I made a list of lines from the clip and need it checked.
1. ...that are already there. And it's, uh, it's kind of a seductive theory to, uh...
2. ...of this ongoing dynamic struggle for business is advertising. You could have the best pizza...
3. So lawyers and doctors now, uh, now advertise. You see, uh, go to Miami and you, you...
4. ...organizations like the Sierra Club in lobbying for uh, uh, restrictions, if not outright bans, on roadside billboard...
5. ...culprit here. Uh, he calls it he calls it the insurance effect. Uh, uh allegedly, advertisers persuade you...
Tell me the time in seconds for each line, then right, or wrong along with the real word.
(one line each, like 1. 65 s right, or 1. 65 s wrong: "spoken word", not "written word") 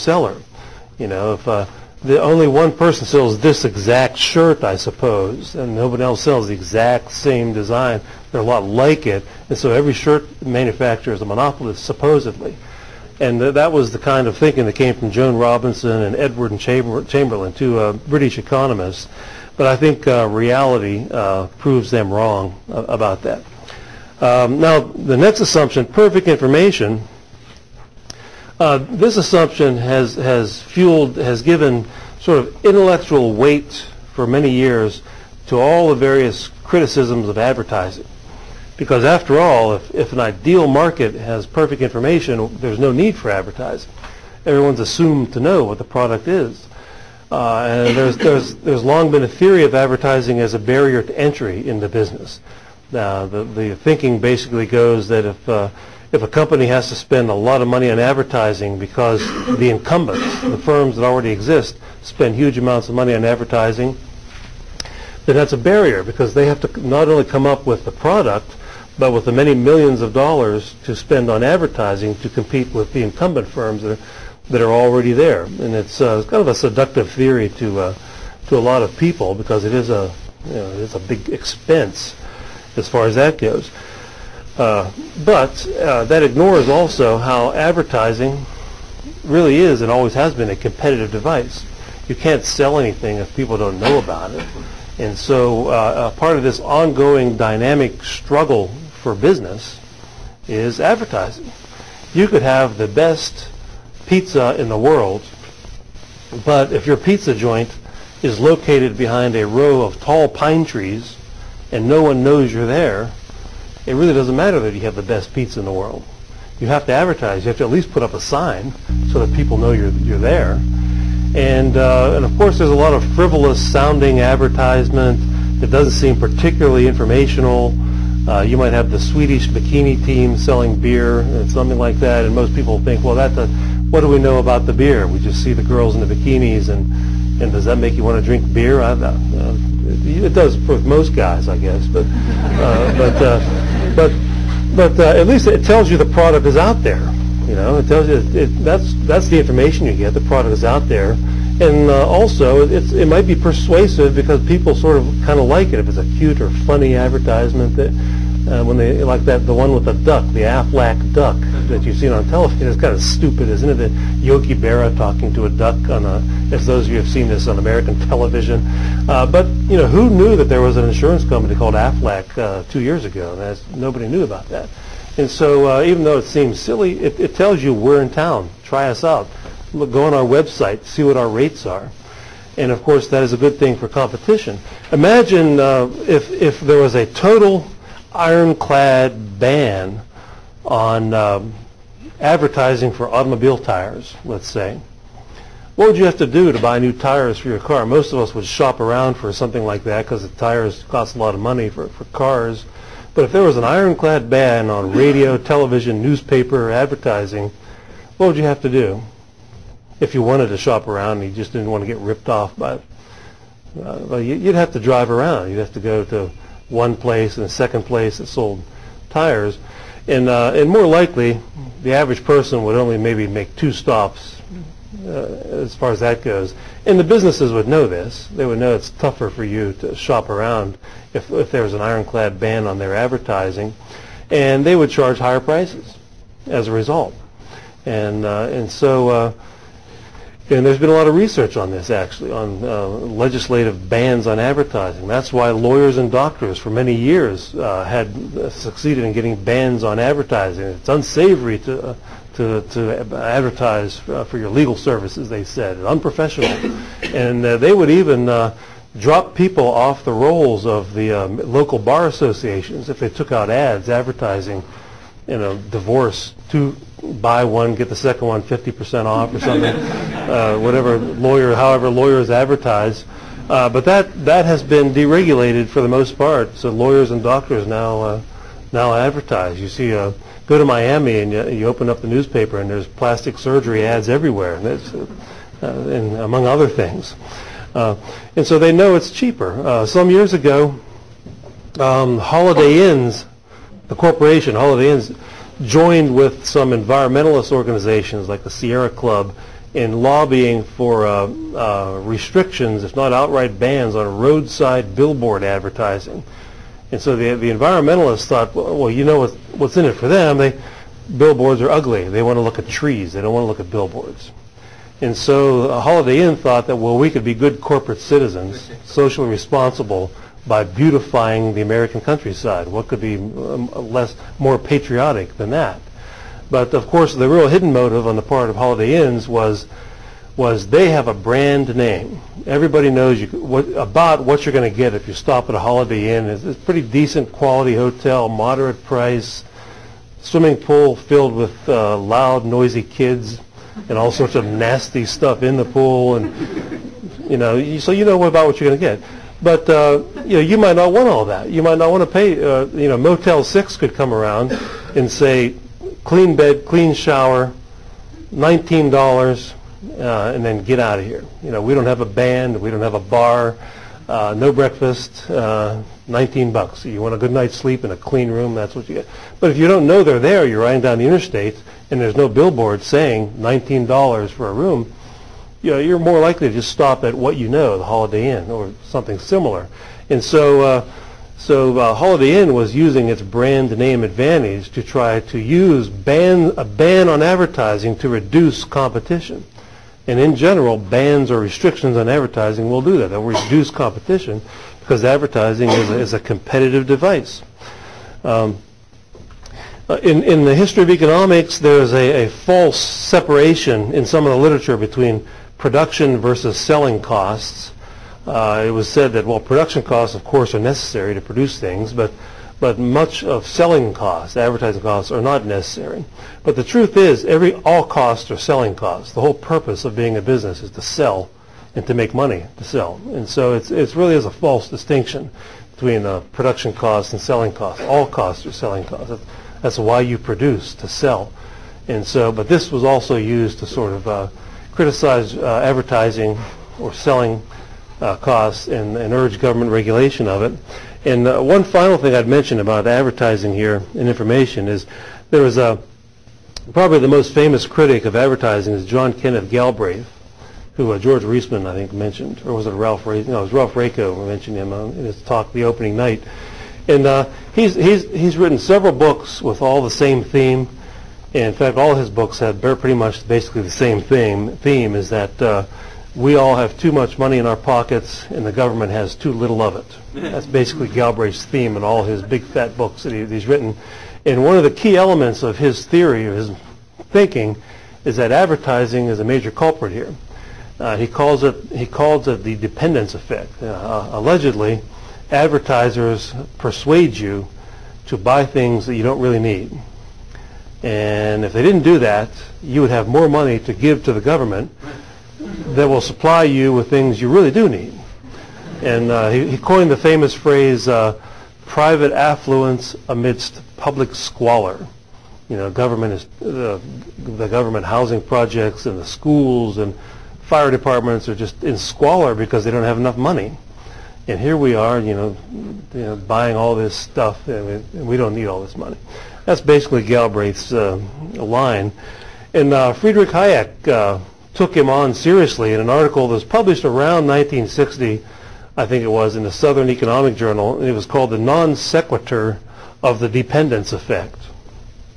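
1. 74 s right
2. 96 s right
3. 276 s right
4. 297 s right
5. 479 s wrong: "dependence", not "insurance".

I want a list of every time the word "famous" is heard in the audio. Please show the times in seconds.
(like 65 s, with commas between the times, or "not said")
447 s, 499 s.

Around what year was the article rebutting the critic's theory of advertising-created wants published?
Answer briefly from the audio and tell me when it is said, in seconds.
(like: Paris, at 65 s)
1960, at 527 s.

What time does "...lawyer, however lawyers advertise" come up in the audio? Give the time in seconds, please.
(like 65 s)
270 s.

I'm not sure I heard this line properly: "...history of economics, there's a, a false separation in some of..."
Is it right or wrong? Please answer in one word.
right.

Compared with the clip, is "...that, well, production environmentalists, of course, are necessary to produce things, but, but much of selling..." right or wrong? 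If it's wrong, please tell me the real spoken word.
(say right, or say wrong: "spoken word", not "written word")
wrong: "costs", not "environmentalists".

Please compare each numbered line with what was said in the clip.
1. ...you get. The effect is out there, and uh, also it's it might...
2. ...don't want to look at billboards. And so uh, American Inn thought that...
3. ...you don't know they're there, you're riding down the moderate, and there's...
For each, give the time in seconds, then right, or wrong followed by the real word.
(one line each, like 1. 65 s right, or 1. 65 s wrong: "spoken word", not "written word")
1. 149 s wrong: "product", not "effect"
2. 313 s wrong: "Holiday", not "American"
3. 369 s wrong: "interstate", not "moderate".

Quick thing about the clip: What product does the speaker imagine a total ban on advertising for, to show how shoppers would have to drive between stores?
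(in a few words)
automobile tires.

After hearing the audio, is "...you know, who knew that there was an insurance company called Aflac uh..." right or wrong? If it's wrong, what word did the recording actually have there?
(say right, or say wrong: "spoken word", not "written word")
right.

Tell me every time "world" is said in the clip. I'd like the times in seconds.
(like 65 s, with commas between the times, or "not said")
104 s, 115 s.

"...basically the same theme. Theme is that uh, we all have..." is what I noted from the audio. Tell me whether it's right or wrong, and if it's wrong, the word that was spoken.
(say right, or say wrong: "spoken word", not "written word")
right.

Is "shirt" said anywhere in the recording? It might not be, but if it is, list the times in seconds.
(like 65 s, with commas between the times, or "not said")
4 s, 9 s.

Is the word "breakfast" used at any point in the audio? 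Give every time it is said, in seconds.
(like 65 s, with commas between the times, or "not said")
364 s.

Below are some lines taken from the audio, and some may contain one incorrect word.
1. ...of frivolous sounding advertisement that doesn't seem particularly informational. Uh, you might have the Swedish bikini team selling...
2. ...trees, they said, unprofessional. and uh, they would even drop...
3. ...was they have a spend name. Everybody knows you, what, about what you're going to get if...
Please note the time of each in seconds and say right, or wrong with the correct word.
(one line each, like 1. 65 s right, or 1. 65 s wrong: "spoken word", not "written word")
1. 122 s right
2. 254 s wrong: "services", not "trees"
3. 330 s wrong: "brand", not "spend".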